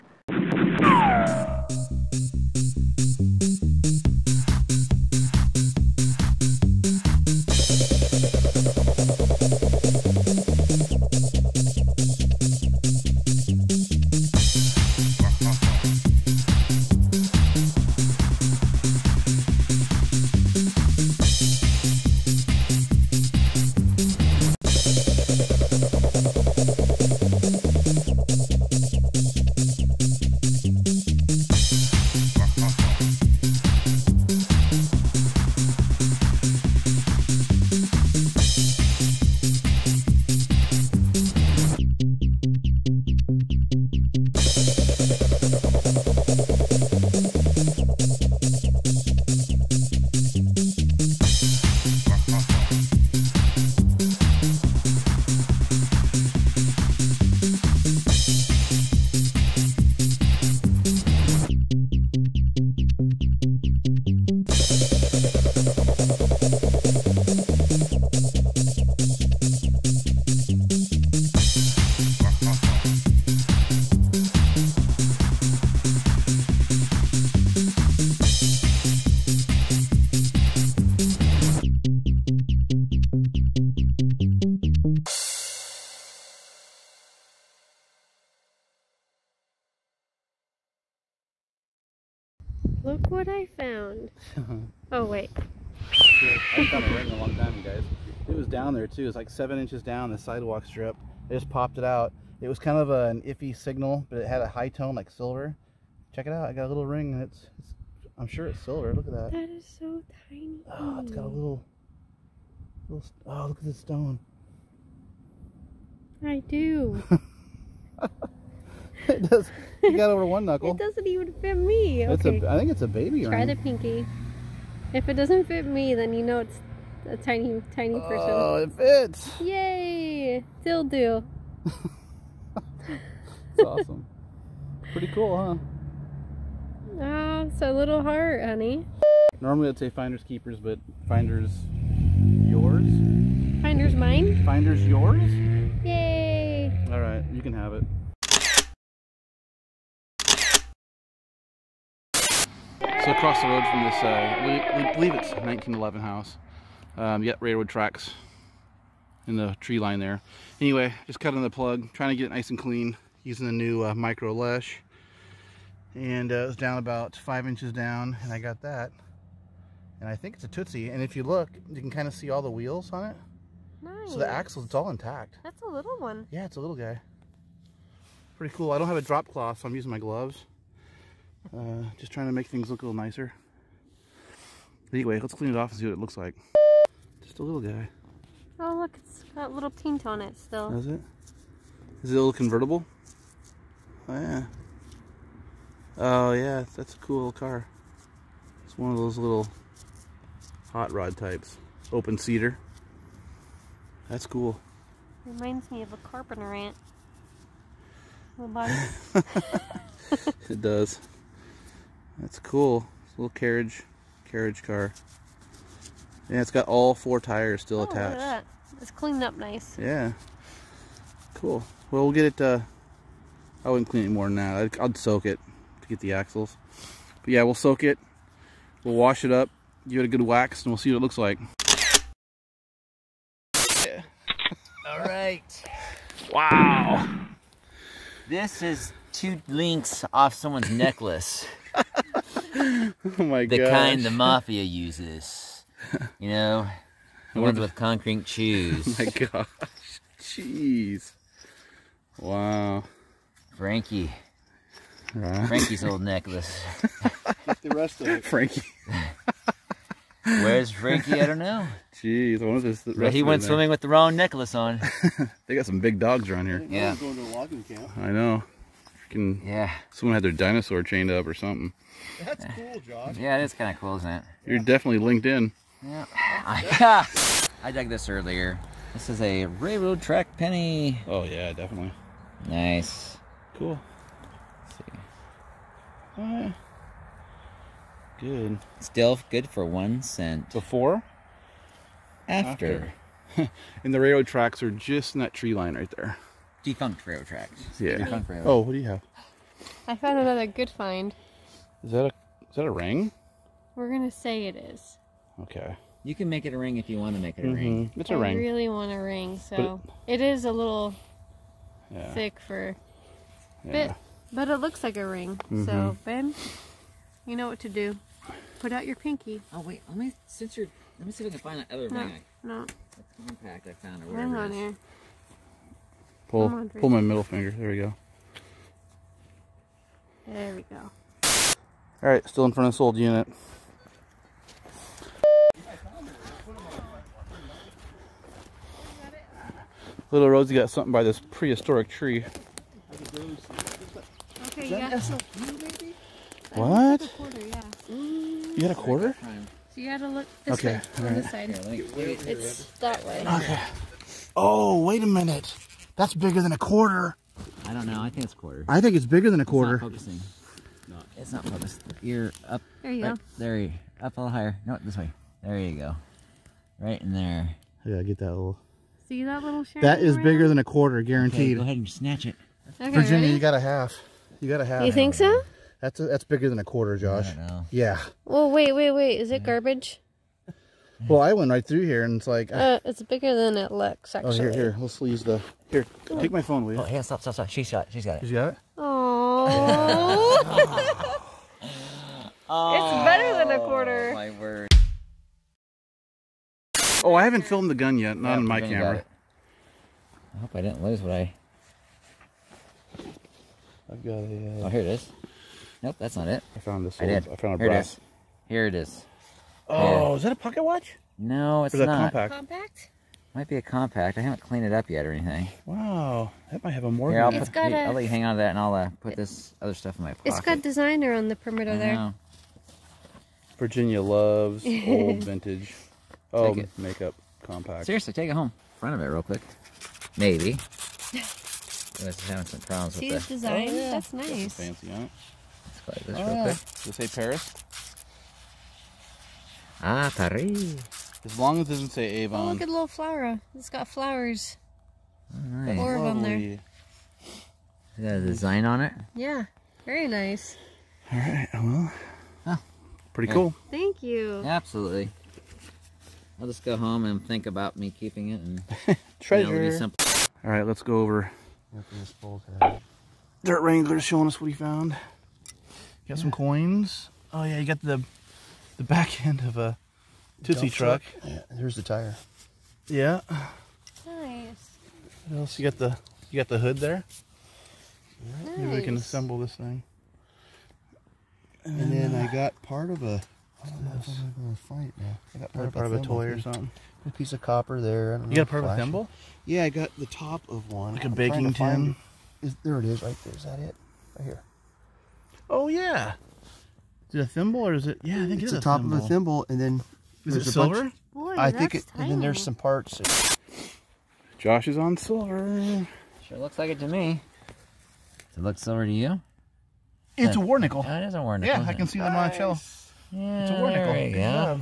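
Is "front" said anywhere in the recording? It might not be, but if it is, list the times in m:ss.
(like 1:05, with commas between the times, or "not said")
5:32, 7:08.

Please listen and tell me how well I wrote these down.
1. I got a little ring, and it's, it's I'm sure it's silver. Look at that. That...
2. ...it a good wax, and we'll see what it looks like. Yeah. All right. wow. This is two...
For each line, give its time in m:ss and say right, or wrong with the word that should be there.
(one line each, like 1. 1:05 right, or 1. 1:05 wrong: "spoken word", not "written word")
1. 1:46 right
2. 3:50 right.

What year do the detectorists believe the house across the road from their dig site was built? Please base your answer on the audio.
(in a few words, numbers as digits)
1911.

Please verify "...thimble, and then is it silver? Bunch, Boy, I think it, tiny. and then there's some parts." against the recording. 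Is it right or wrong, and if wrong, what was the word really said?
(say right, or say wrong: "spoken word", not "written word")
right.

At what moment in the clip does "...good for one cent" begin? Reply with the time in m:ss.
4:49.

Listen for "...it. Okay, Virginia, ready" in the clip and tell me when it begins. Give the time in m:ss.
6:12.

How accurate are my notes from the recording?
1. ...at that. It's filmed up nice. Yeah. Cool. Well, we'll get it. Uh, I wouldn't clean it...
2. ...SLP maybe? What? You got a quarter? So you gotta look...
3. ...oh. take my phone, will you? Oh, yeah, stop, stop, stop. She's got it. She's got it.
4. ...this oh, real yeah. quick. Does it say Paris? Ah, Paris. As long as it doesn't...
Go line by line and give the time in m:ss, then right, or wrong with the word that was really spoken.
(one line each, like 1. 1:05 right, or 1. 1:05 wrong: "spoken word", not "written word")
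1. 3:38 wrong: "cleaned", not "filmed"
2. 5:44 right
3. 6:26 right
4. 7:16 right.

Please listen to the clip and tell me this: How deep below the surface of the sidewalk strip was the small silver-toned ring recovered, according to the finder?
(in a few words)
7 inches.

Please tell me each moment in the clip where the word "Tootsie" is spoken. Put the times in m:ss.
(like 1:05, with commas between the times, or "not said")
2:50, 7:50.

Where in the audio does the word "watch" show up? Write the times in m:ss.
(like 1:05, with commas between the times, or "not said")
6:50.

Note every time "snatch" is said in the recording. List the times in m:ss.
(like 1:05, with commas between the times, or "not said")
6:11.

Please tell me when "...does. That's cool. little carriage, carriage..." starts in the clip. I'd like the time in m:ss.
3:30.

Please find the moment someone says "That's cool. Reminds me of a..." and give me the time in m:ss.
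3:24.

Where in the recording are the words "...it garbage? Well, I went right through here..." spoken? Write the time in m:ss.
6:19.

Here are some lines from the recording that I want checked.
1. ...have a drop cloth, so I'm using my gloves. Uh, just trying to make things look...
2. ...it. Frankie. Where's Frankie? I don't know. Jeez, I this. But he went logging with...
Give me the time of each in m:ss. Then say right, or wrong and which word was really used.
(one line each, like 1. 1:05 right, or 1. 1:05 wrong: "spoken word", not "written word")
1. 2:58 right
2. 4:18 wrong: "swimming", not "logging".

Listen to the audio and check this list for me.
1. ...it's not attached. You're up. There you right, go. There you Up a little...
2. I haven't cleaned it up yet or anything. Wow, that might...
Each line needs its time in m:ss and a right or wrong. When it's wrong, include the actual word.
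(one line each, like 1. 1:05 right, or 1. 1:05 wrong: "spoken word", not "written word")
1. 6:01 wrong: "focused", not "attached"
2. 6:54 right.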